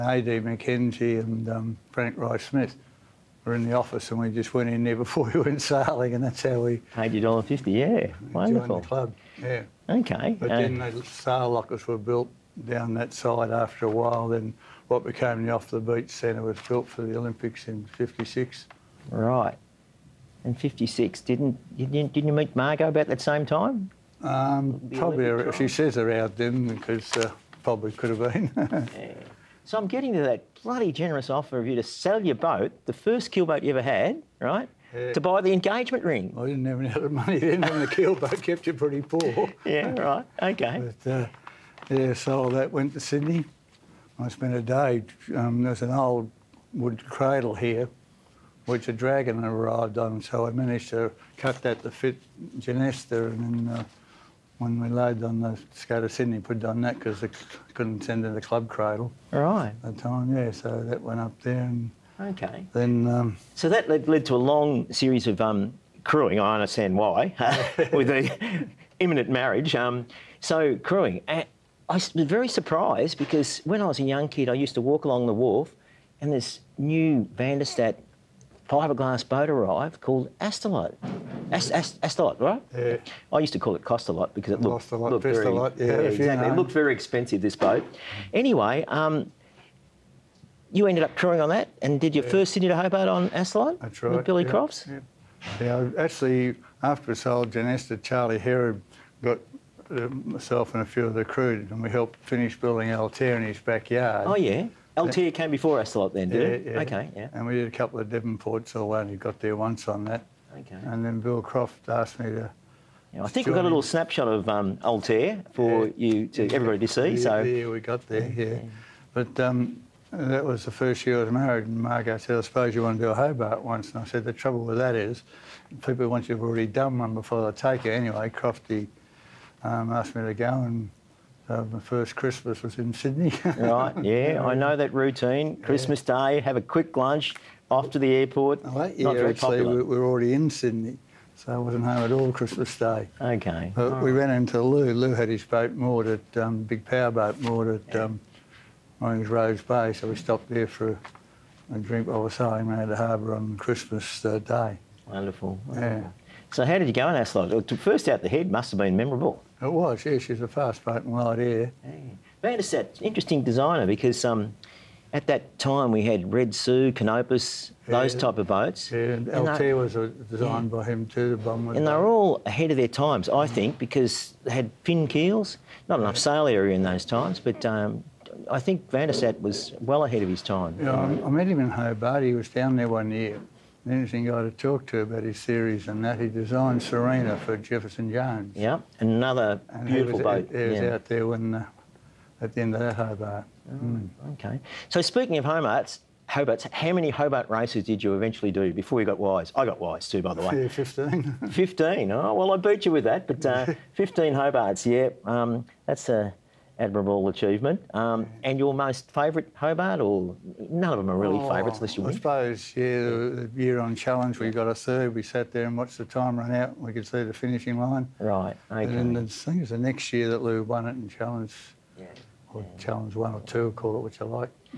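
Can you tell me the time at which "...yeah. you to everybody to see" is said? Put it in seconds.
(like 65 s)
115 s.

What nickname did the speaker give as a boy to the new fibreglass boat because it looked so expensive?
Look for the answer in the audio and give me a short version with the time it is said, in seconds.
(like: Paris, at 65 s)
Costalot, at 83 s.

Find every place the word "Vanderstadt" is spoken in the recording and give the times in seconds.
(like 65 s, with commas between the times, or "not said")
77 s, 178 s.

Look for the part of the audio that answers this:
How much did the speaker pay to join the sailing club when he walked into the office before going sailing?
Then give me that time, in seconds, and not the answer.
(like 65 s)
7 s.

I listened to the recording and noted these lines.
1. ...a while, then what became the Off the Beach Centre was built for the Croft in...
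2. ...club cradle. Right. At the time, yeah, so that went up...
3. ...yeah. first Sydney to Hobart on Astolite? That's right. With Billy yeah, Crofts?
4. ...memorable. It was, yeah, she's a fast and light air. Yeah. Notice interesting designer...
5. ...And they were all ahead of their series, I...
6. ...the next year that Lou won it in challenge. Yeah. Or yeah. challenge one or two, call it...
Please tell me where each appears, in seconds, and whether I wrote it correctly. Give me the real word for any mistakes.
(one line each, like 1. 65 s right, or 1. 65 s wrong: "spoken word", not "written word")
1. 13 s wrong: "Olympics", not "Croft"
2. 58 s right
3. 92 s right
4. 158 s right
5. 171 s wrong: "times", not "series"
6. 219 s right.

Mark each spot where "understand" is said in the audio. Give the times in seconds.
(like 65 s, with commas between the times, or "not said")
66 s.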